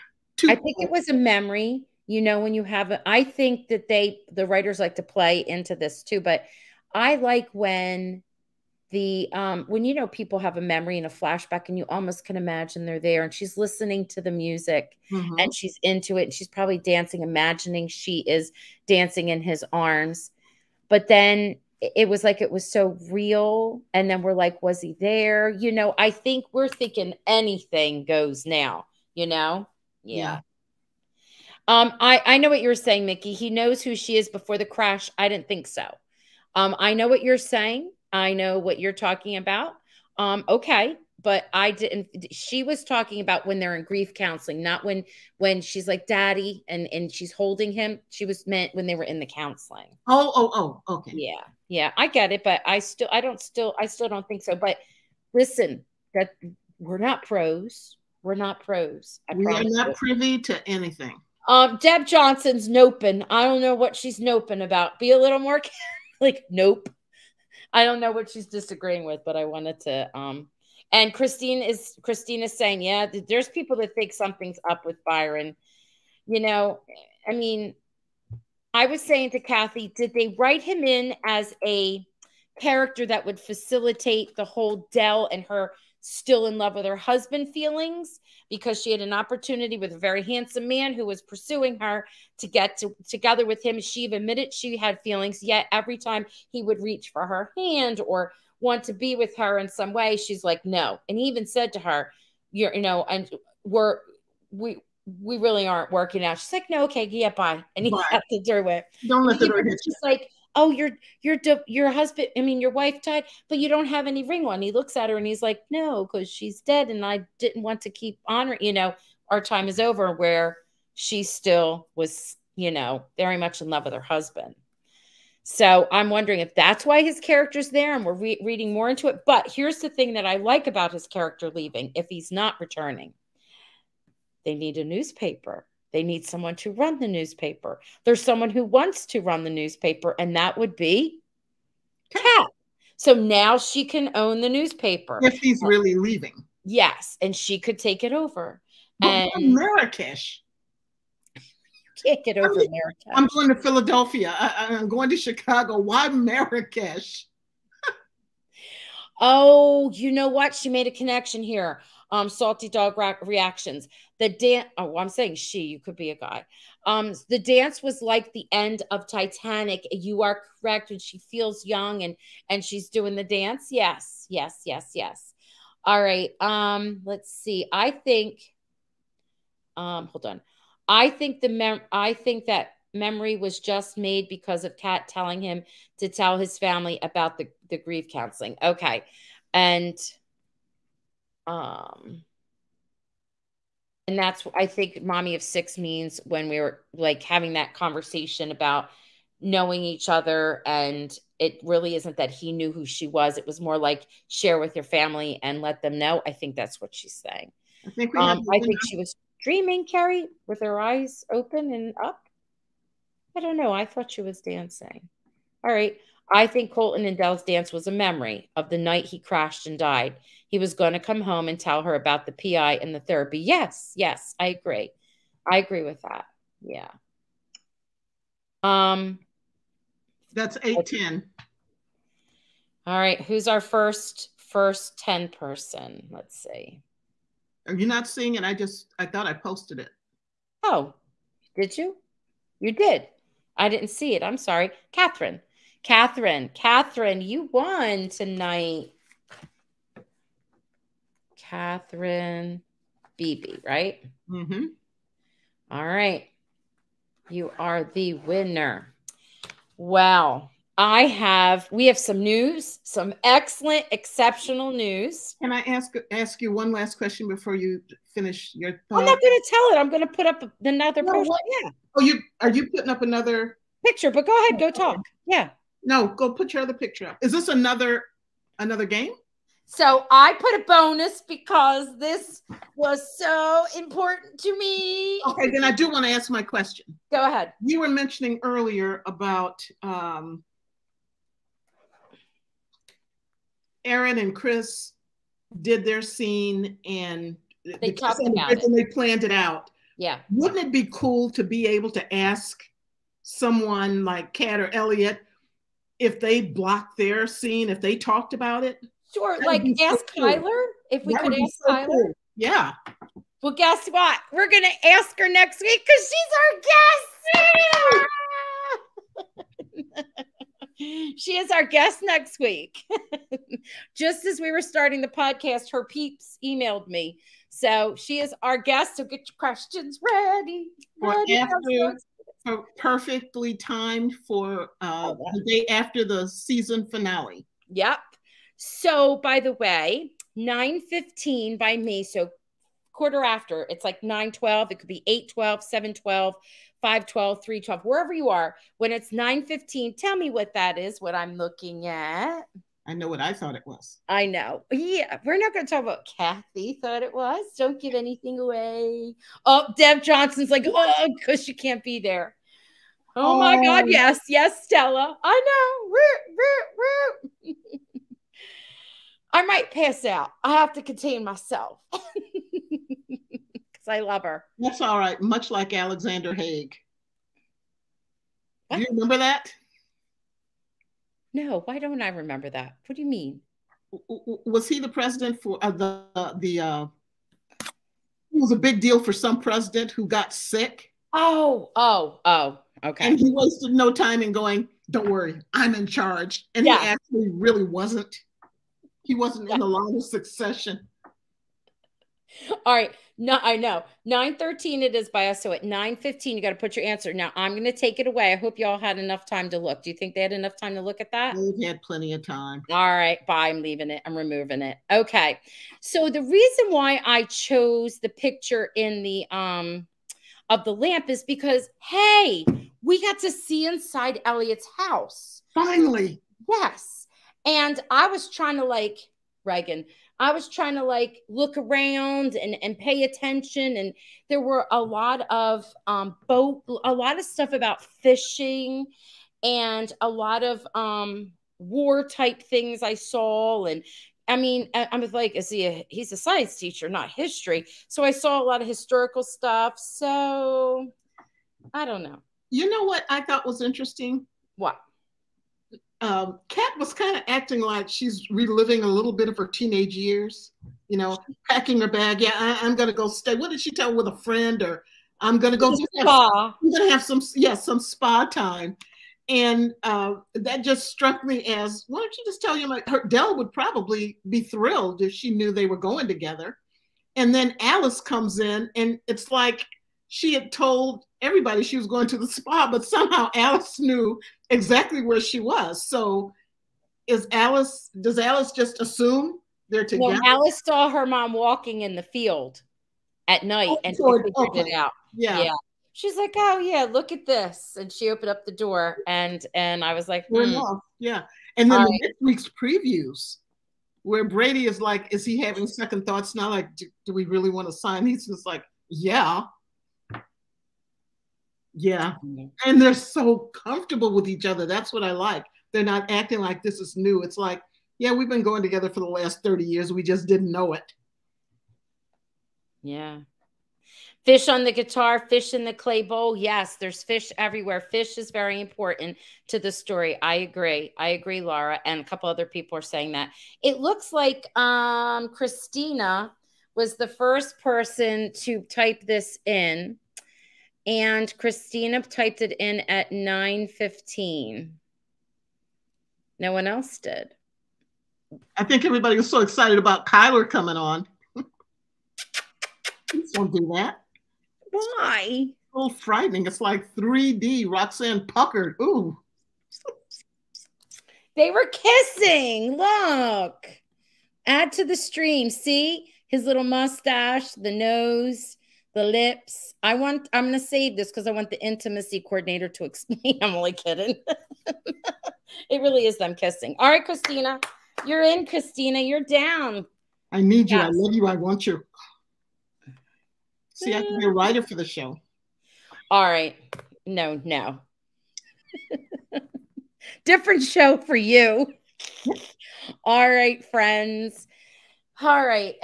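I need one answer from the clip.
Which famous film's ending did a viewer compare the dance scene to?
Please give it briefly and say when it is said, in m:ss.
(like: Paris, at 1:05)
Titanic, at 2:49.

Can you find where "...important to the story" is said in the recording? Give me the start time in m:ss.
8:48.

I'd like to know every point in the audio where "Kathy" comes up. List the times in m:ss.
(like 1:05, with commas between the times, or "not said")
1:19, 5:56.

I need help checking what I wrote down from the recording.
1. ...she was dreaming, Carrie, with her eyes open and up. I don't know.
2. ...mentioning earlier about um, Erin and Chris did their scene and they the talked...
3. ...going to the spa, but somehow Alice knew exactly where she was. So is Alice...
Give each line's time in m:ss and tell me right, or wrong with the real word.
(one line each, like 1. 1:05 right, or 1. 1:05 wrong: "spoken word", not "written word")
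1. 3:28 right
2. 4:47 right
3. 8:01 right.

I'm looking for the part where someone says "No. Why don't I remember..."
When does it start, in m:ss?
6:21.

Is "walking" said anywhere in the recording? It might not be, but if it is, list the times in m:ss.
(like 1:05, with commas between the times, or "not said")
8:11.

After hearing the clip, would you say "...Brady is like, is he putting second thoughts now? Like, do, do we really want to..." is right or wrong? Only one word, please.
wrong.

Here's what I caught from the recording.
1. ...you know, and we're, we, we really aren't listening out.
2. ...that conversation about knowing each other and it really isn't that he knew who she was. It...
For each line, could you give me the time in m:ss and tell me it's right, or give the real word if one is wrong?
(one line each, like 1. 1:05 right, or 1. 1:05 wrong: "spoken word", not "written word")
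1. 1:42 wrong: "working", not "listening"
2. 3:17 right.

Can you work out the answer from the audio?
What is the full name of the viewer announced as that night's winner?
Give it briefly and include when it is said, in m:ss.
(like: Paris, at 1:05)
Catherine Beebe, at 4:11.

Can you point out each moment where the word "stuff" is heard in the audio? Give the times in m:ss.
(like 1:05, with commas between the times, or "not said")
7:17, 7:29.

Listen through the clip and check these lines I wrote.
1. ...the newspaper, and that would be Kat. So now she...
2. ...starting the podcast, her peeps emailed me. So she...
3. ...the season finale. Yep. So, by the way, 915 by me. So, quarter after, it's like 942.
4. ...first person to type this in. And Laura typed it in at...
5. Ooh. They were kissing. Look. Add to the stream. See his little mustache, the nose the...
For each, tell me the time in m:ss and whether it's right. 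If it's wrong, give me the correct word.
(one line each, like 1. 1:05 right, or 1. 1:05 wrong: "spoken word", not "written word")
1. 2:19 right
2. 5:24 right
3. 5:36 wrong: "912", not "942"
4. 8:57 wrong: "Christina", not "Laura"
5. 9:18 right.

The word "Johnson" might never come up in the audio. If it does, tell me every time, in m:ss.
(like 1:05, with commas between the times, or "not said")
1:02, 6:00.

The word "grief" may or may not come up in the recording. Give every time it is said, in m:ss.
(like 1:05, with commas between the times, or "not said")
0:43, 3:07.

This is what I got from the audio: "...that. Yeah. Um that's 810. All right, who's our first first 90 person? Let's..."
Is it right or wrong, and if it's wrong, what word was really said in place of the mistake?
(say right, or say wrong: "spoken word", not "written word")
wrong: "10", not "90".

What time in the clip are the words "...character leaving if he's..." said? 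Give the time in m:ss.
2:11.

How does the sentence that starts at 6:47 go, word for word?
Now I'm gonna take it away.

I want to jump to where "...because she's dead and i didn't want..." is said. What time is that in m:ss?
1:56.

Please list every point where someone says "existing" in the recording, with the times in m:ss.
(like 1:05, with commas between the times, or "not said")
not said.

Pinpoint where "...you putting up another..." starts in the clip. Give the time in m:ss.
4:32.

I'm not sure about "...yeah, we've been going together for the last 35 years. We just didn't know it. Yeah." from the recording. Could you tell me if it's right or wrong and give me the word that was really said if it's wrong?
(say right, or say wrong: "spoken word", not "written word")
wrong: "30", not "35".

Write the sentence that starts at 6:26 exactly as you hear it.
Uh, it was a big deal for some president who got sick.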